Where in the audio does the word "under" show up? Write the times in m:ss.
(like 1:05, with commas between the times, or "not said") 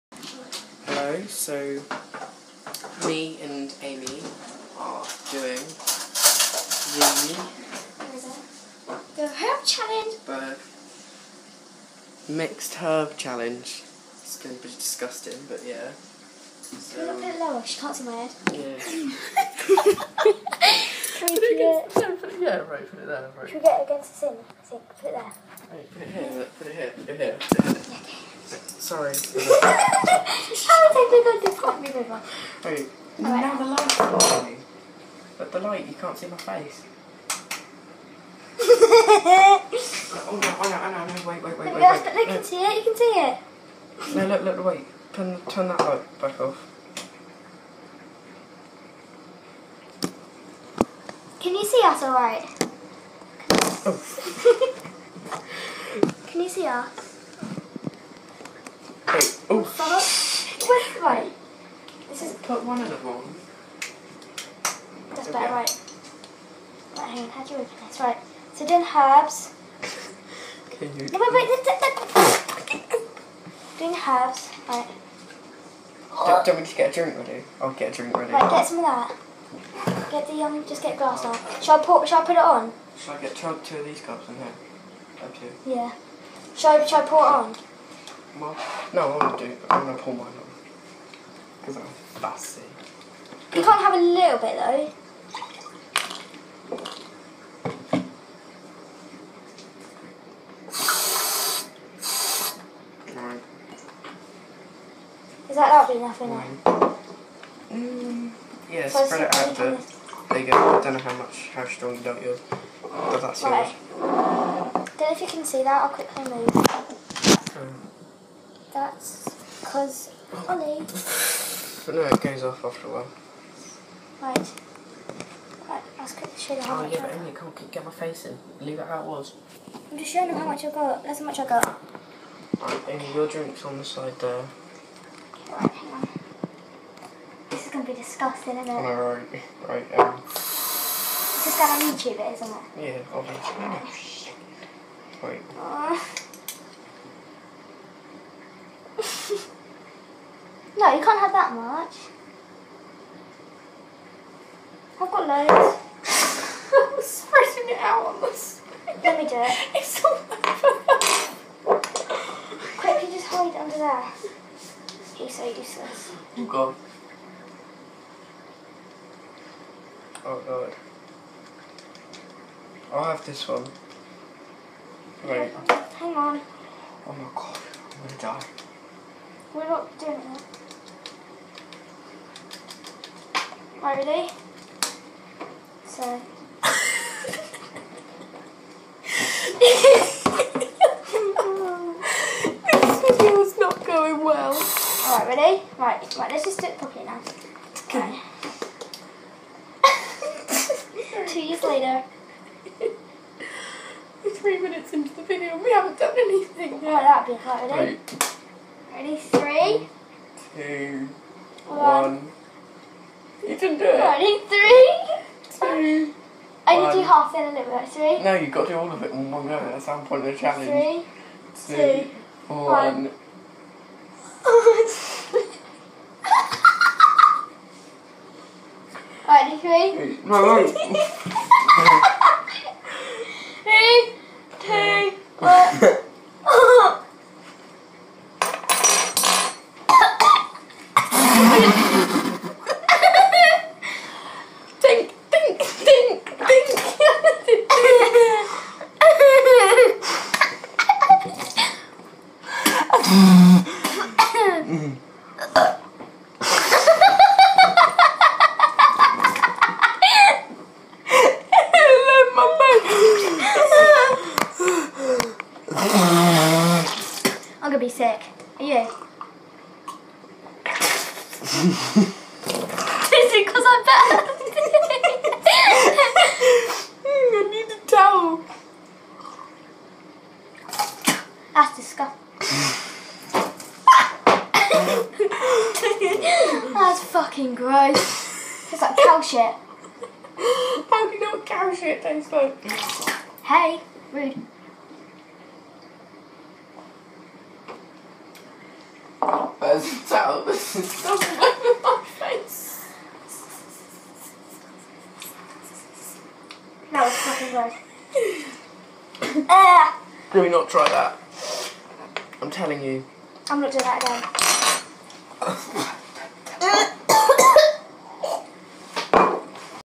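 2:43.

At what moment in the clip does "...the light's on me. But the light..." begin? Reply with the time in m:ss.
0:33.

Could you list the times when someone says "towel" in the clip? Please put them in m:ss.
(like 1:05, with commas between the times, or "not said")
4:37, 5:00.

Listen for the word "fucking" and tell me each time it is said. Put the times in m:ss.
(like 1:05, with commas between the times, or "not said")
4:47, 5:07.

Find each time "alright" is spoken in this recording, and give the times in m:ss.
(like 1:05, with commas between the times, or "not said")
0:52, 3:15.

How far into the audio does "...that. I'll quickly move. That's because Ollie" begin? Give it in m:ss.
1:55.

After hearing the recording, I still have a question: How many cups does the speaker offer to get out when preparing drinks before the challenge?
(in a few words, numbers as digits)
2.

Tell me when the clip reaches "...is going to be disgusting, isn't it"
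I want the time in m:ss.
2:17.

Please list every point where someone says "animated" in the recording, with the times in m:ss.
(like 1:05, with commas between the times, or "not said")
not said.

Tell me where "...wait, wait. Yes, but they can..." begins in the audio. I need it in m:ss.
0:41.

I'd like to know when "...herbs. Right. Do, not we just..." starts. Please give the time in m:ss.
1:14.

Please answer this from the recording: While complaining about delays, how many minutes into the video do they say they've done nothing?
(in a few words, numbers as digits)
3.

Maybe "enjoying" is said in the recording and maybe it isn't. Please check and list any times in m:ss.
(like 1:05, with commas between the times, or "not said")
not said.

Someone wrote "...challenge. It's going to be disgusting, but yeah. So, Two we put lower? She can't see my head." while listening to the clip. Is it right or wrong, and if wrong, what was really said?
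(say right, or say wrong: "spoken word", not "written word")
wrong: "Can", not "Two".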